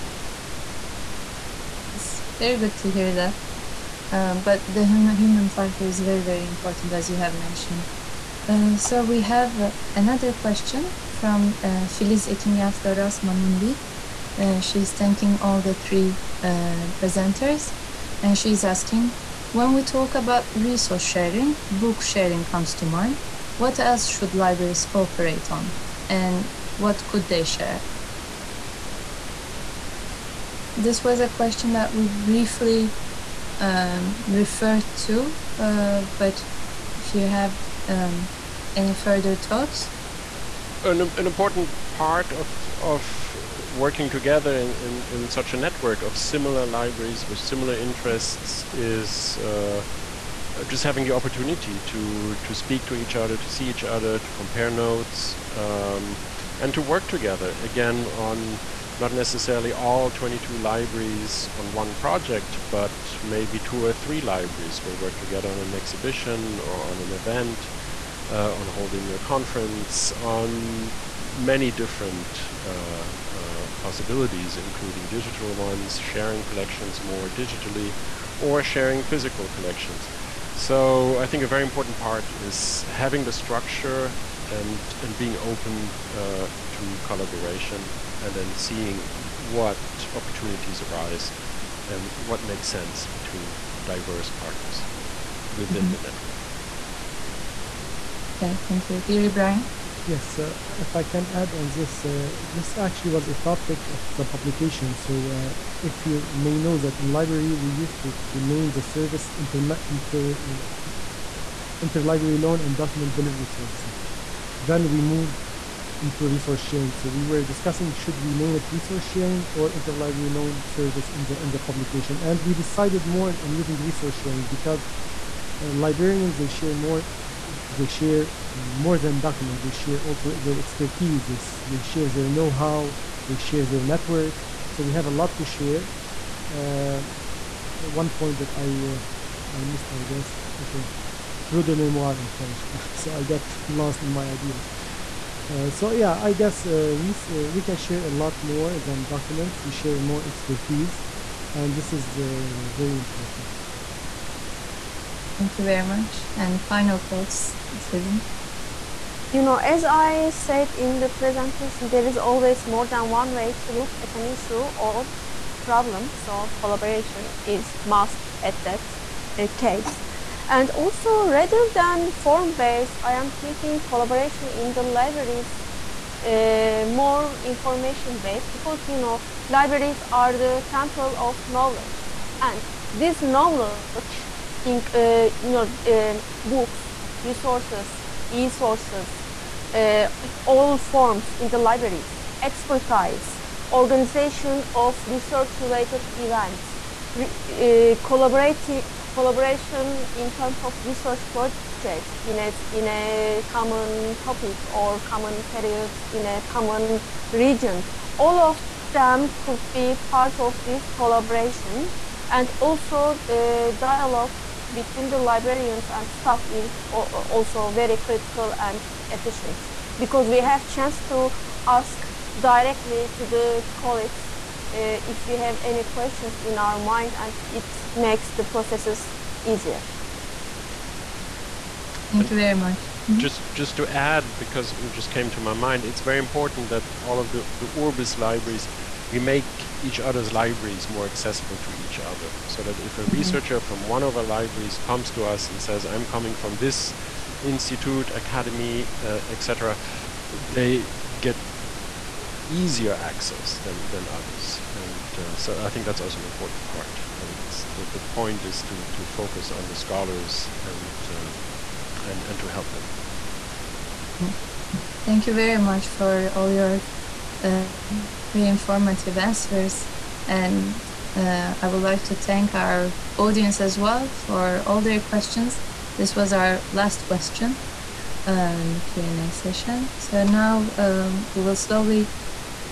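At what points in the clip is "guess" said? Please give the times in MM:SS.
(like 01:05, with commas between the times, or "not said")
02:20, 02:26.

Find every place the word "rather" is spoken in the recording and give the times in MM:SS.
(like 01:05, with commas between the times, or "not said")
02:51.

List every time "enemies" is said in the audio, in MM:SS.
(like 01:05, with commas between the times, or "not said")
not said.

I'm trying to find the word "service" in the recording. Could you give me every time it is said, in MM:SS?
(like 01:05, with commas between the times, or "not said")
01:48, 01:53, 02:00.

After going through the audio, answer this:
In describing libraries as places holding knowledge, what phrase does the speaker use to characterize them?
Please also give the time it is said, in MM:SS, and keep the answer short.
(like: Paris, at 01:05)
temple of knowledge, at 03:00.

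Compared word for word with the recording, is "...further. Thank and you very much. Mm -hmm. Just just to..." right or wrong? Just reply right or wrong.
wrong.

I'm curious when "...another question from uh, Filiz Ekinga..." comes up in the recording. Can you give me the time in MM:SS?
00:09.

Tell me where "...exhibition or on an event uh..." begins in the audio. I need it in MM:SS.
01:05.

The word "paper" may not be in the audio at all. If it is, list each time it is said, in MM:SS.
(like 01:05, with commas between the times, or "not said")
not said.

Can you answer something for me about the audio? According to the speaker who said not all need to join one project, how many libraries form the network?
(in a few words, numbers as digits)
22.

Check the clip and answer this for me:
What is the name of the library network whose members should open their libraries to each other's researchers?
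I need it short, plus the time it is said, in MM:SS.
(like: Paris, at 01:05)
Urbis, at 03:57.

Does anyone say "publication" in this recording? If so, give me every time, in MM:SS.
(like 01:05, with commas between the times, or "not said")
01:44, 02:01.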